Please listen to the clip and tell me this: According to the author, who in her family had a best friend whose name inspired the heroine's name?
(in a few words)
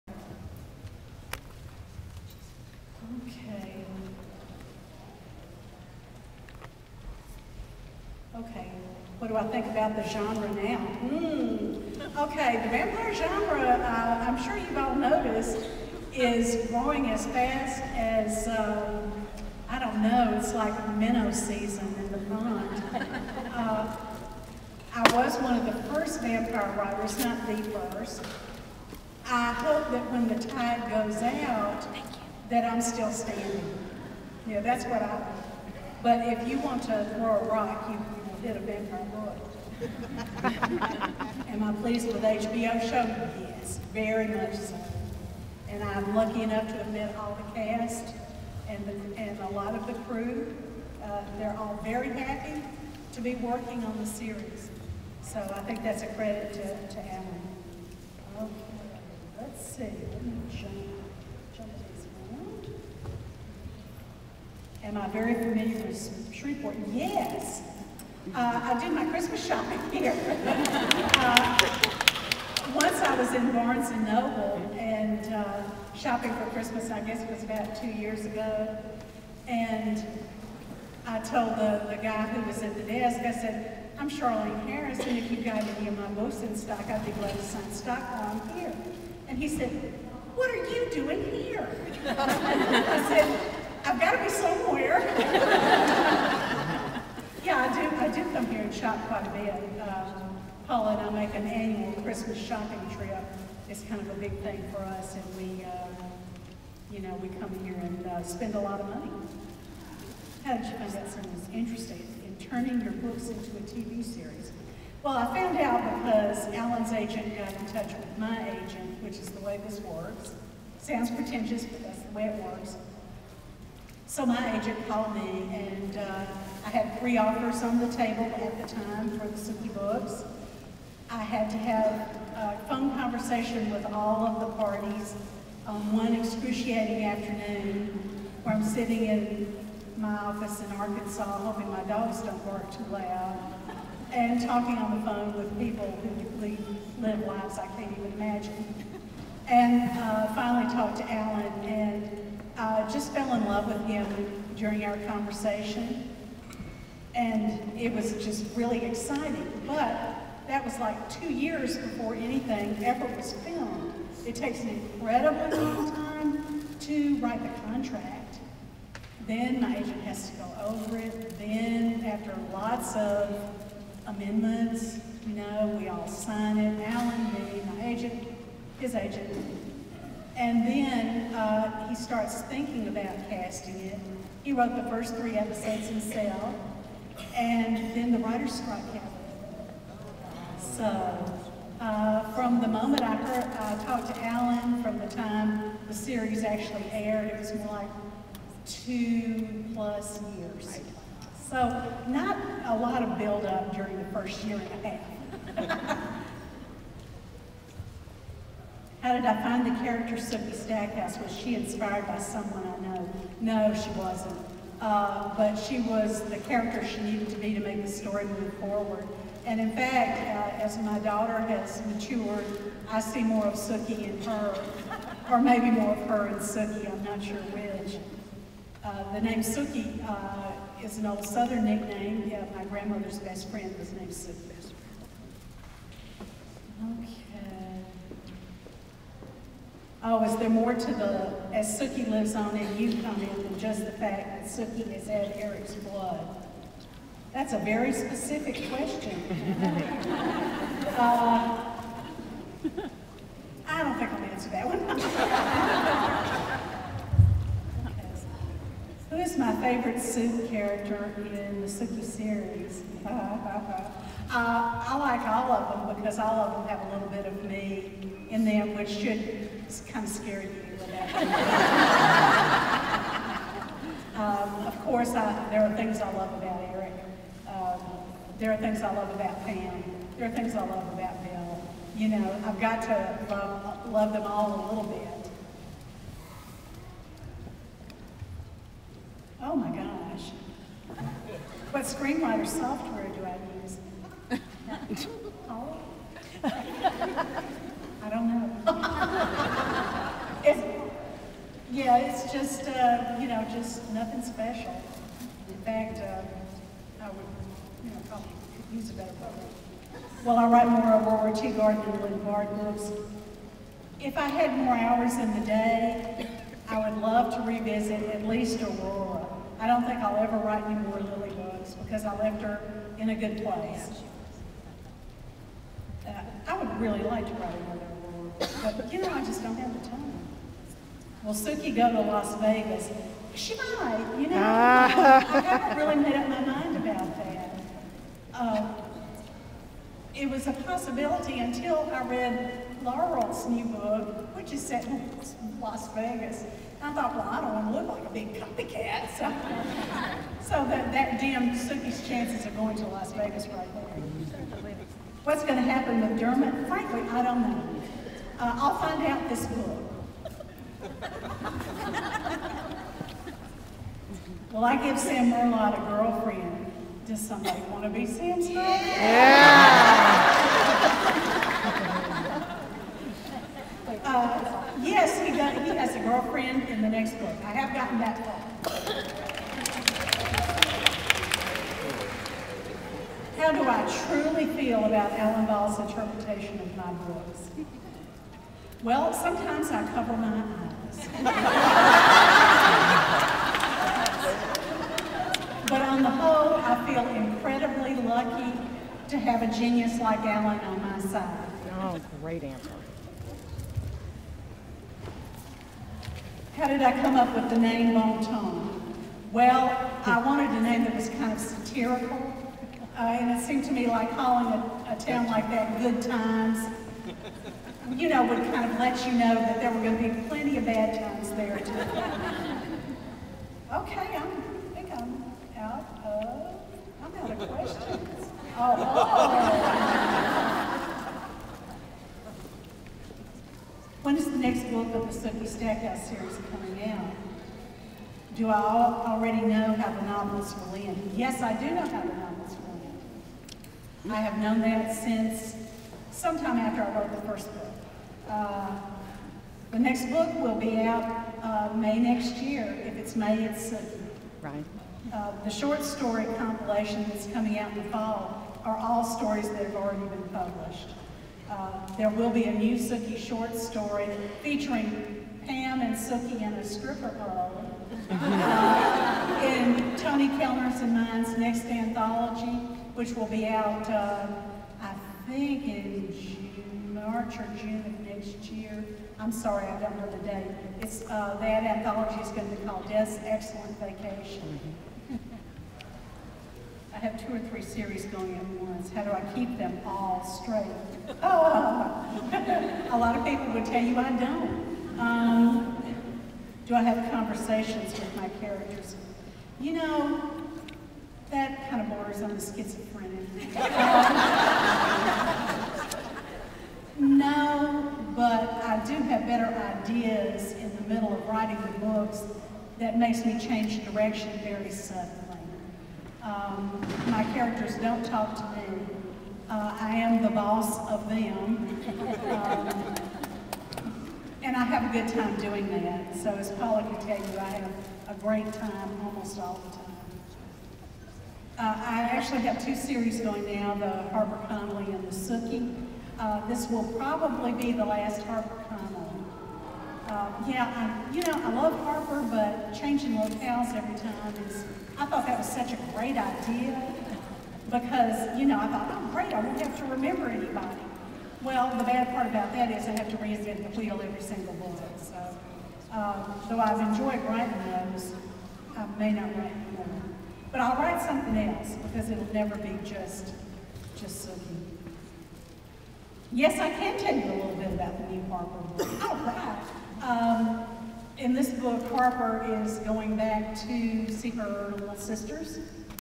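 grandmother.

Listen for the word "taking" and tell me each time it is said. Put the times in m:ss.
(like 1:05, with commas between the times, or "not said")
not said.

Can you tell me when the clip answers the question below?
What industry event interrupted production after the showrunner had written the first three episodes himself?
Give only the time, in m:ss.
3:08.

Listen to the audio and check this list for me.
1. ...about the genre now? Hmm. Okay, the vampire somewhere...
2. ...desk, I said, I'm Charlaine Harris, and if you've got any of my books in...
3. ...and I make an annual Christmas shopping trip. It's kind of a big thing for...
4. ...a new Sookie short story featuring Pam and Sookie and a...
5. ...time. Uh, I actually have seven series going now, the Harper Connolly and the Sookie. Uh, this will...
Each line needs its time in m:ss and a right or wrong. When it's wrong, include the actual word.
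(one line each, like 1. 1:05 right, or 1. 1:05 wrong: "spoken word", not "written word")
1. 0:09 wrong: "genre", not "somewhere"
2. 1:22 right
3. 1:40 right
4. 7:42 right
5. 8:49 wrong: "two", not "seven".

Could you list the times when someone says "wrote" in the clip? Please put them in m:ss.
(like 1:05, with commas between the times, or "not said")
3:04, 7:27.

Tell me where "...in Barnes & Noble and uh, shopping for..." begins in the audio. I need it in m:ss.
1:13.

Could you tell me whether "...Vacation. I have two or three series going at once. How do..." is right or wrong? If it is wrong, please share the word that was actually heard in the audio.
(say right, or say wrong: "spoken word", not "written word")
right.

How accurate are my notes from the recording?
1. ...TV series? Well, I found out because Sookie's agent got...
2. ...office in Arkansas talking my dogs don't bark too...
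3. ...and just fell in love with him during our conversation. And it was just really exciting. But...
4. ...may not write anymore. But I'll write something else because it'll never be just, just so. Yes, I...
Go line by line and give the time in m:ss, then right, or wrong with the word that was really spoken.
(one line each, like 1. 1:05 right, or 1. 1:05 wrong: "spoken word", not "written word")
1. 1:53 wrong: "Alan", not "Sookie"
2. 2:20 wrong: "hoping", not "talking"
3. 2:31 right
4. 9:18 right.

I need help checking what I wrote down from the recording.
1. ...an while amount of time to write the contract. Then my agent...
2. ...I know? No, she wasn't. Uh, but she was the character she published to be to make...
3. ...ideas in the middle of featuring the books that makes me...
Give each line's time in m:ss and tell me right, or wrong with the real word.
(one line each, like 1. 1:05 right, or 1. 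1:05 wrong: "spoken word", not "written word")
1. 2:44 wrong: "incredible", not "while"
2. 3:32 wrong: "needed", not "published"
3. 8:29 wrong: "writing", not "featuring".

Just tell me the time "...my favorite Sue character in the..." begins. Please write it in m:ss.
4:19.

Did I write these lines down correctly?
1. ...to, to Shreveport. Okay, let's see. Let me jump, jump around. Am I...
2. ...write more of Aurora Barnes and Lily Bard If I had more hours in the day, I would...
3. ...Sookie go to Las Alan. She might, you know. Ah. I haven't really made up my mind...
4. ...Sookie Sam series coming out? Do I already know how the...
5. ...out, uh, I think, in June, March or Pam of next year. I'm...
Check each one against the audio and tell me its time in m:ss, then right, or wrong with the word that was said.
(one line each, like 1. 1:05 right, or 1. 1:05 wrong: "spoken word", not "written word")
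1. 0:56 wrong: "Alan", not "Shreveport"
2. 5:10 wrong: "Teagarden", not "Barnes"
3. 5:31 wrong: "Vegas", not "Alan"
4. 7:15 wrong: "Stackhouse", not "Sam"
5. 7:53 wrong: "June", not "Pam".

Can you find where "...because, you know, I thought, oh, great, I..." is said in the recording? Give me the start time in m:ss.
9:07.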